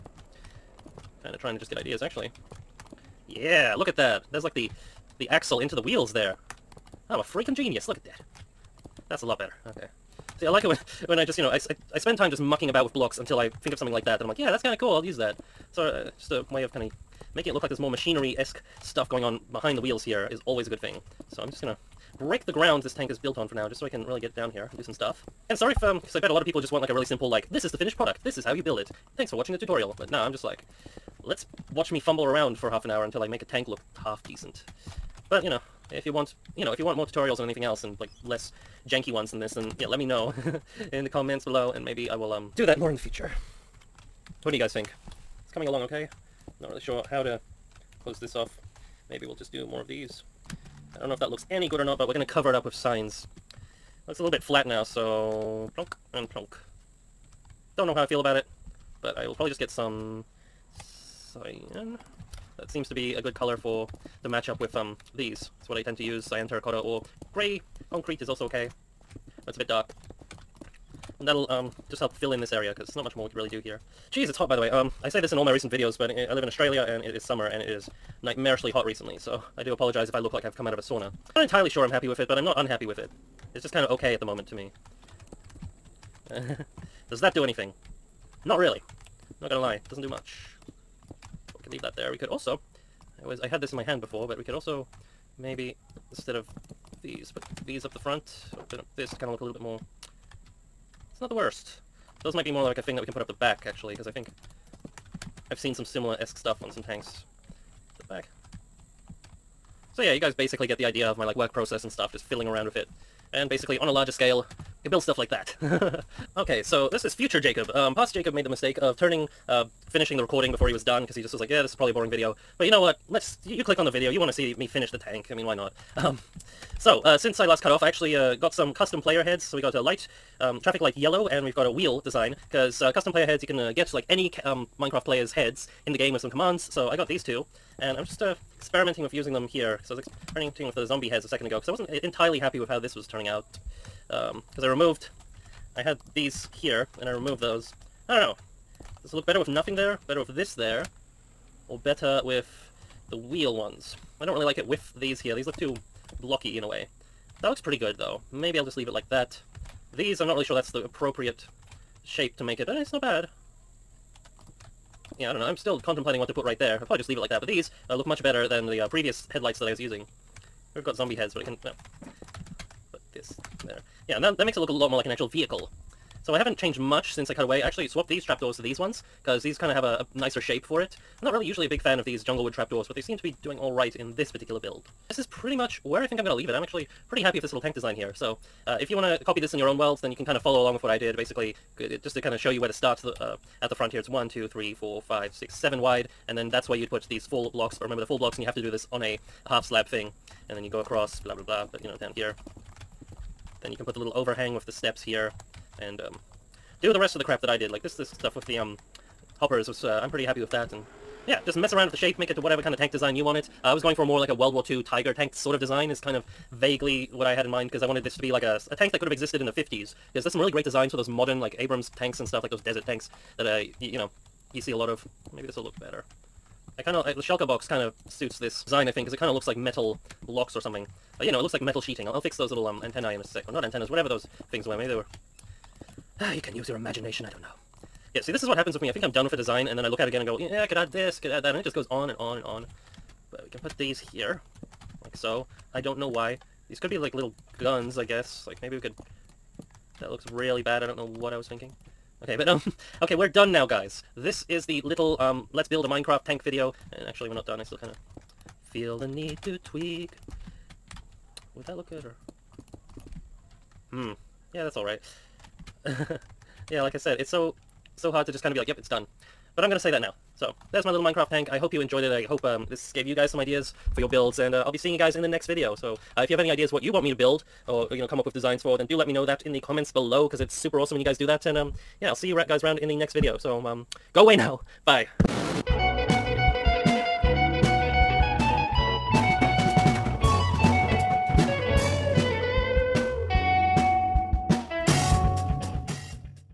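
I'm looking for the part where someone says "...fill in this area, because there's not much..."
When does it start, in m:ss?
1:12.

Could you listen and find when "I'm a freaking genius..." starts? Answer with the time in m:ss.
0:07.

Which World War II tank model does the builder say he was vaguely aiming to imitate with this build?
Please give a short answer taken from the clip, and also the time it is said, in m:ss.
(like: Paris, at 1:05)
Tiger tank, at 3:34.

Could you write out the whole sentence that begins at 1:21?
I'm not entirely sure I'm happy with it, but I'm not unhappy with it.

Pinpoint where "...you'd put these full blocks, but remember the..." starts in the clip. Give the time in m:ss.
3:16.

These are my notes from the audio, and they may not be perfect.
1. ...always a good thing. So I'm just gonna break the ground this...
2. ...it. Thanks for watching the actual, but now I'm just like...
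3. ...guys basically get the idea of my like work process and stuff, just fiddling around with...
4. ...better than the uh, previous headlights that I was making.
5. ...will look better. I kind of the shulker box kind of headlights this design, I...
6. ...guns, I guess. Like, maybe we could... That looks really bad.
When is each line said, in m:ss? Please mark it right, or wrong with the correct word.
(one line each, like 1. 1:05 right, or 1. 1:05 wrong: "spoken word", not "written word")
1. 0:20 right
2. 0:28 wrong: "tutorial", not "actual"
3. 1:50 right
4. 2:48 wrong: "using", not "making"
5. 3:45 wrong: "suits", not "headlights"
6. 4:07 right.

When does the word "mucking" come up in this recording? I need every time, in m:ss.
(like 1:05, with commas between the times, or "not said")
0:12.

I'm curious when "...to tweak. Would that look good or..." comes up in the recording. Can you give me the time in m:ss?
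4:19.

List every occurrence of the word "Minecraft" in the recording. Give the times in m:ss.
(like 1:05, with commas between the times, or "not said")
2:14, 4:15, 4:31.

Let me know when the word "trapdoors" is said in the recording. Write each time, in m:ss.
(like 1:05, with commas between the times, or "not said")
2:58, 3:02.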